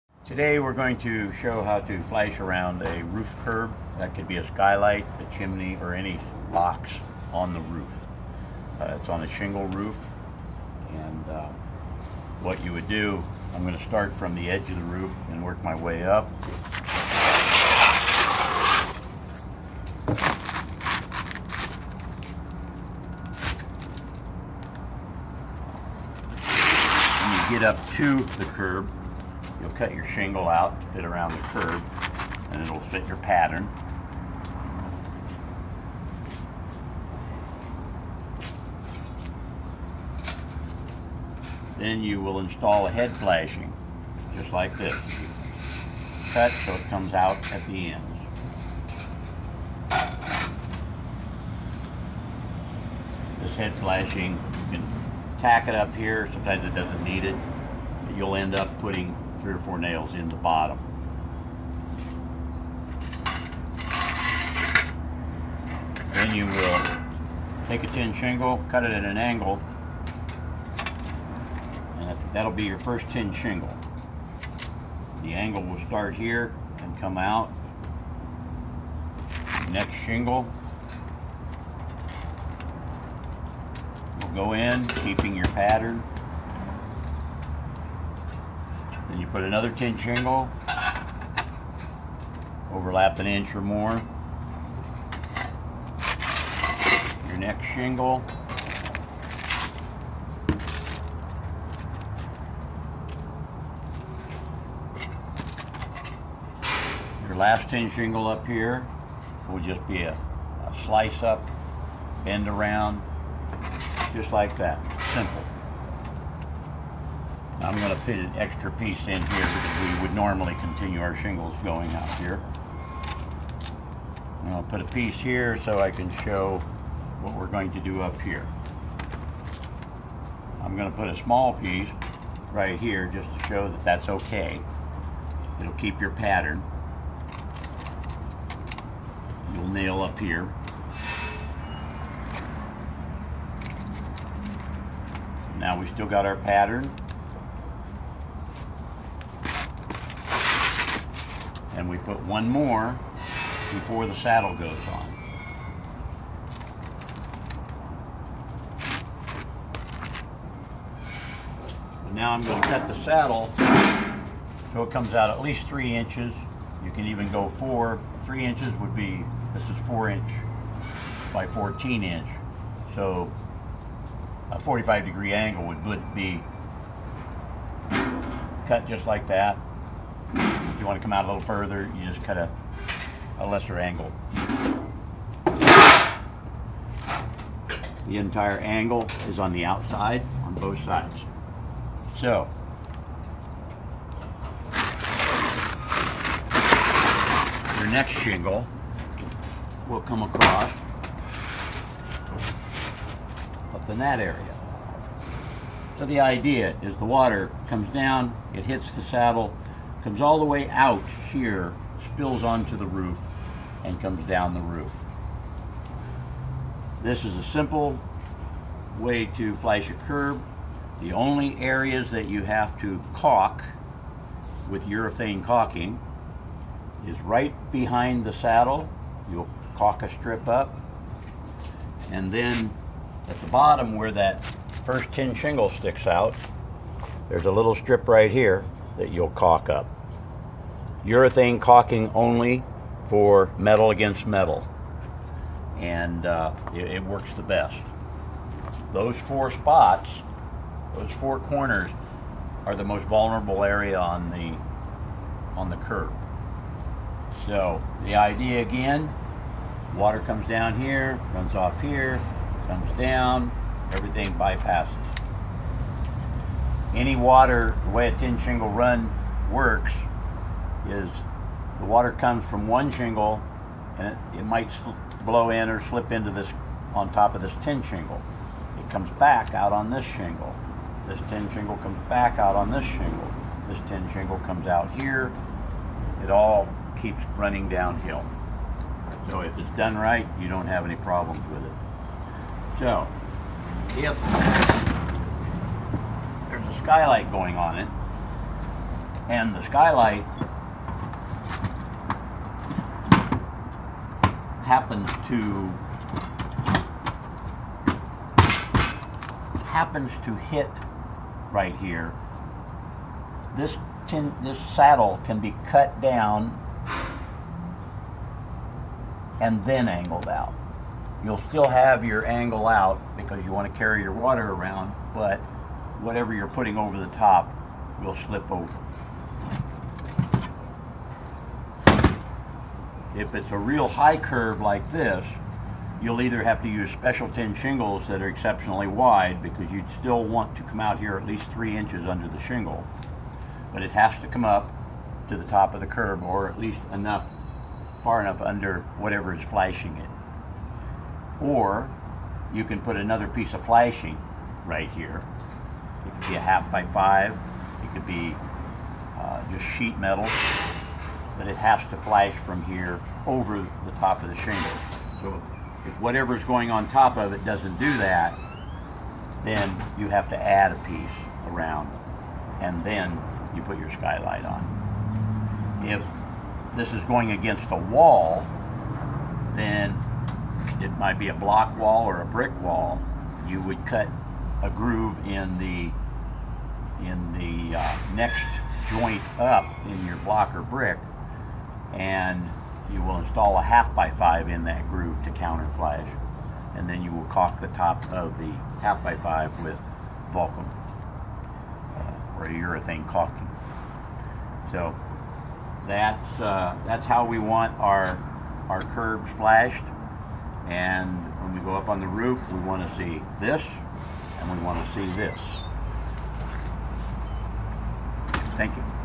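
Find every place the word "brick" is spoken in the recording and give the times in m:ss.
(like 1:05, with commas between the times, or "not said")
6:22, 6:30.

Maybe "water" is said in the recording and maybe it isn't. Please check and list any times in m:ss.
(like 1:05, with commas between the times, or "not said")
3:27, 4:19, 4:27, 4:31, 5:24.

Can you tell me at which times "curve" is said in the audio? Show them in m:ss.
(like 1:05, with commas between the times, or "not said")
5:34.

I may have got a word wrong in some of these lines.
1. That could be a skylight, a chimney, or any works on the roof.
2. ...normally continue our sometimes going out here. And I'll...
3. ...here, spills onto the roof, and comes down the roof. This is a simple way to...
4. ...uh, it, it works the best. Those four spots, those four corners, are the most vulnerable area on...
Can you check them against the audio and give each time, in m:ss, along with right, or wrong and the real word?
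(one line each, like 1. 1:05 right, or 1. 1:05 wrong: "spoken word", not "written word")
1. 0:03 wrong: "locks", not "works"
2. 2:00 wrong: "shingles", not "sometimes"
3. 3:31 right
4. 4:06 right.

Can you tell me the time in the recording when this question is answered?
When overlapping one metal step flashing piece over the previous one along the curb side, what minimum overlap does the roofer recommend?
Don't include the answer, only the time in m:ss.
1:33.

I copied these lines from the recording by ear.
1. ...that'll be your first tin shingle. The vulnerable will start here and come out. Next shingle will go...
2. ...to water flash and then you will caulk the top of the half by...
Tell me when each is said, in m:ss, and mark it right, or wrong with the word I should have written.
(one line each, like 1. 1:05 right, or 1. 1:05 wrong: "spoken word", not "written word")
1. 1:12 wrong: "angle", not "vulnerable"
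2. 6:35 wrong: "counter", not "water".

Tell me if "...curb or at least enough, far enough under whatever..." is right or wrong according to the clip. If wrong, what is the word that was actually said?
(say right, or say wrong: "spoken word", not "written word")
right.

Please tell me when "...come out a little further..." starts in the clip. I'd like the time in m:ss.
3:01.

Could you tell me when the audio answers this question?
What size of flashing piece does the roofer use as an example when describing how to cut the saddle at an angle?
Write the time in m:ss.
2:49.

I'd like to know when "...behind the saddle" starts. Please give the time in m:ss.
3:47.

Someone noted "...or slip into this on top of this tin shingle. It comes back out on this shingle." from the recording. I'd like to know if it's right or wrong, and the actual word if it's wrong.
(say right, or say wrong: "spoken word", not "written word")
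right.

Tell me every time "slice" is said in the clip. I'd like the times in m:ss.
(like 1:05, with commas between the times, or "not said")
1:50.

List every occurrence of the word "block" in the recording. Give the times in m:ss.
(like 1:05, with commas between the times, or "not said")
6:21, 6:30.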